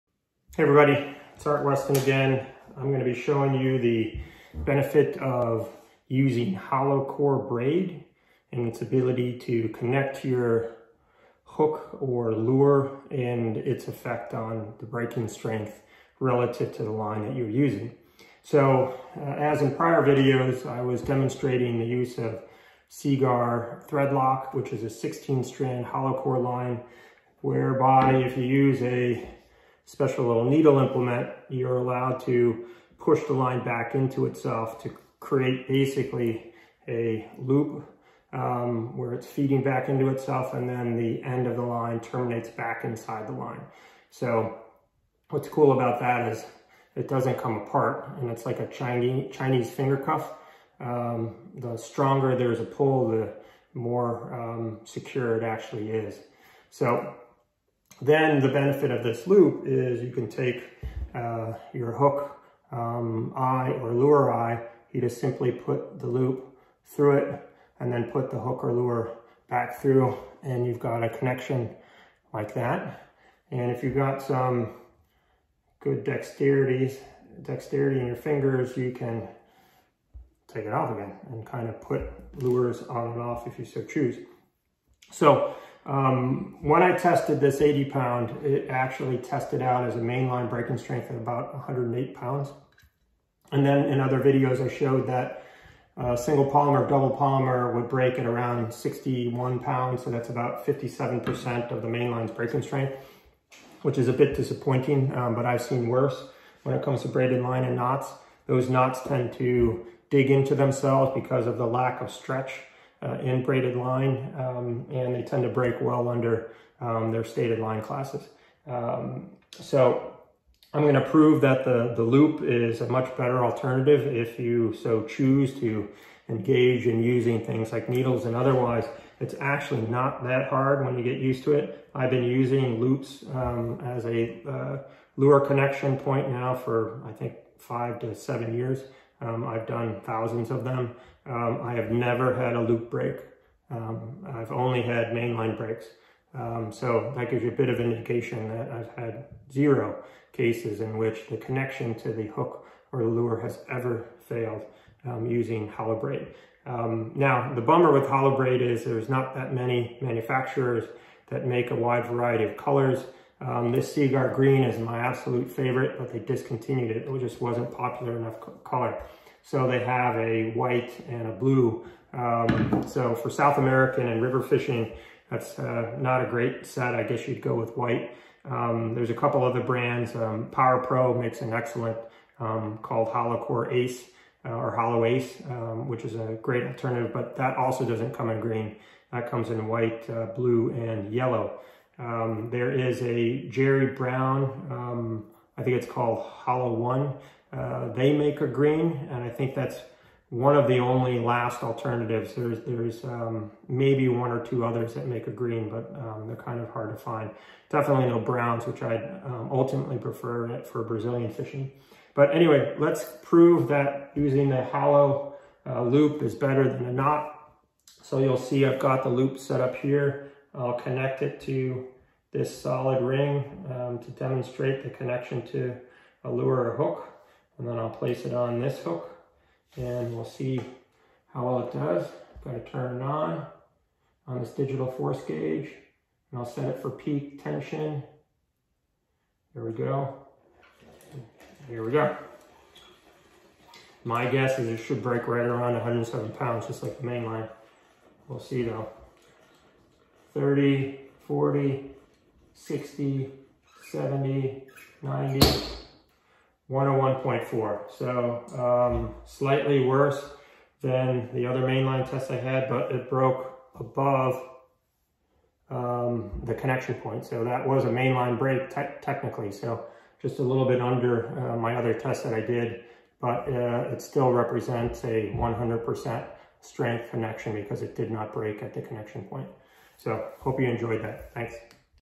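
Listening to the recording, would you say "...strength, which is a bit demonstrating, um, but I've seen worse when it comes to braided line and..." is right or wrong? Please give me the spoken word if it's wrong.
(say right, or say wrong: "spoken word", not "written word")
wrong: "disappointing", not "demonstrating".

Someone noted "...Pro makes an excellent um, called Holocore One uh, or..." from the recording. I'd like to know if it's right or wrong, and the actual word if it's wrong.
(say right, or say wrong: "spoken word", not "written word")
wrong: "Ace", not "One".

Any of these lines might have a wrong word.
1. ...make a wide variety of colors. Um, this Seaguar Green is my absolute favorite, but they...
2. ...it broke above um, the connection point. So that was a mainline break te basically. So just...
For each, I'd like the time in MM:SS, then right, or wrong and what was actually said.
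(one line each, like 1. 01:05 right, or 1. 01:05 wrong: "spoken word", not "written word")
1. 02:41 right
2. 04:22 wrong: "technically", not "basically".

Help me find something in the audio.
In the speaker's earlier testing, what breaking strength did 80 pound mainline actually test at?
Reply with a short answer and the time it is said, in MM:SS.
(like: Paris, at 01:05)
about 108 pounds, at 01:31.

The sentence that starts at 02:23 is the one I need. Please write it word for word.
Um, I've only had mainline breaks.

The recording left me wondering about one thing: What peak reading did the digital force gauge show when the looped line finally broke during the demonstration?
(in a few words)
101.4.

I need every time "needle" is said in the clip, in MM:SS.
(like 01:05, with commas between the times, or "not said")
00:30, 02:07.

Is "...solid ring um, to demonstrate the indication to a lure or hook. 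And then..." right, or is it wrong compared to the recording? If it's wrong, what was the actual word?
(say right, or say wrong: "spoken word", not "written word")
wrong: "connection", not "indication".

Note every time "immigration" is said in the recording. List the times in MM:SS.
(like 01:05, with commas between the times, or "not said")
not said.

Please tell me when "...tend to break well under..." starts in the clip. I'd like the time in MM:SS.
01:55.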